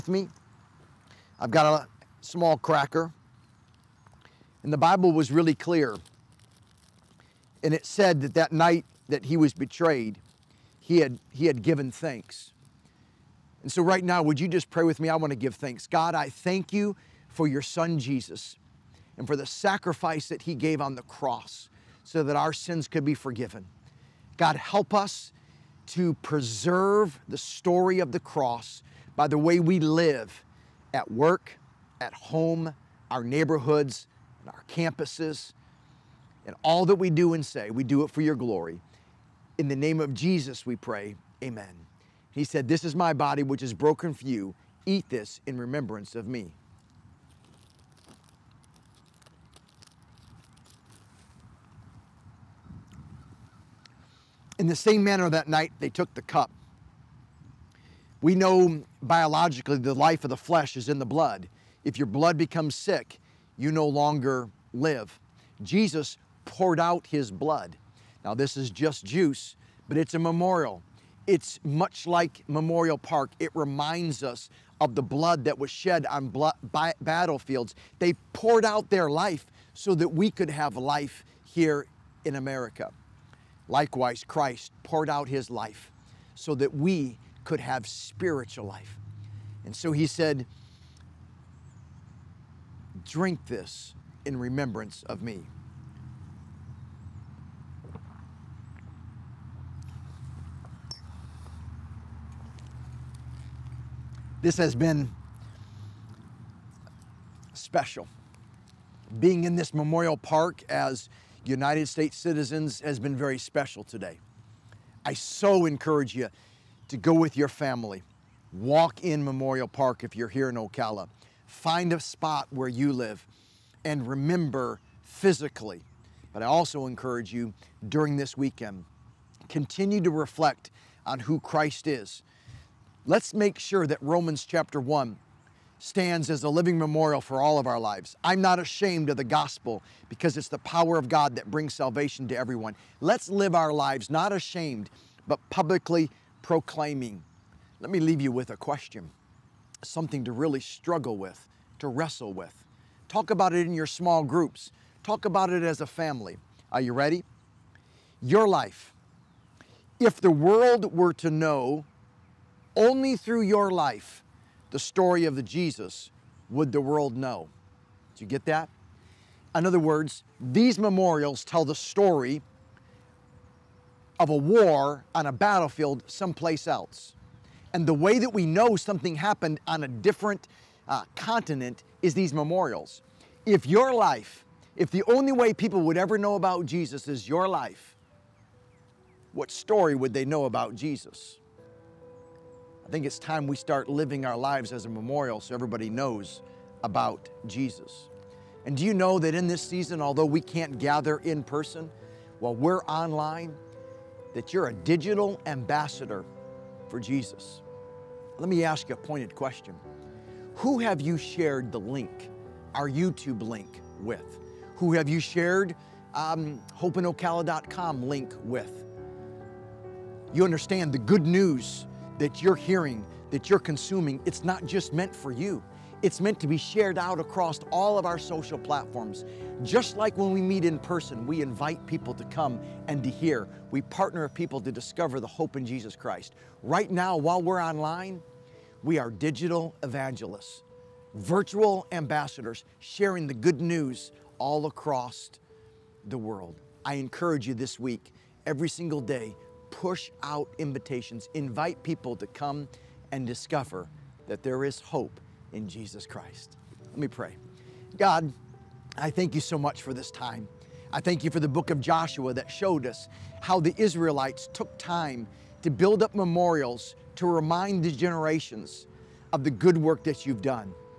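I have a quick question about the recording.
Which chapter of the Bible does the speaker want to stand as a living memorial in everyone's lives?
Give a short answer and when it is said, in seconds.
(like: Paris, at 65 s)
Romans chapter 1, at 134 s.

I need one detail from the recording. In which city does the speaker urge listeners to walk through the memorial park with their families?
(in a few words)
Ocala.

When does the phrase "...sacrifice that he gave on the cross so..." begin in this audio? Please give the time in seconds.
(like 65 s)
19 s.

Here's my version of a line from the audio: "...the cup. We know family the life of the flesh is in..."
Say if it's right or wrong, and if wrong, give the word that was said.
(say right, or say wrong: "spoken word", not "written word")
wrong: "biologically", not "family".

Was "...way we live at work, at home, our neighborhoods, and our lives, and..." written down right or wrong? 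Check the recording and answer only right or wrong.
wrong.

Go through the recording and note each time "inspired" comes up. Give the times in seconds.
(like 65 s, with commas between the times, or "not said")
not said.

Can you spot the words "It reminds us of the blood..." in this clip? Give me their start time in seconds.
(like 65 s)
73 s.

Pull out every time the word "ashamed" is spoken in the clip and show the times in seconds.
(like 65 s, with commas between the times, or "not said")
138 s, 144 s.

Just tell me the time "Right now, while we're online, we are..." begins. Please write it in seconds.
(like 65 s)
236 s.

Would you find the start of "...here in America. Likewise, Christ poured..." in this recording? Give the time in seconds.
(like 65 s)
81 s.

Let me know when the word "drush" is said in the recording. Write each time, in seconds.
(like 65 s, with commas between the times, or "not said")
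not said.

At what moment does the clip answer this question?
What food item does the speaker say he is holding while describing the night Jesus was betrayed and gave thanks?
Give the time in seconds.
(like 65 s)
2 s.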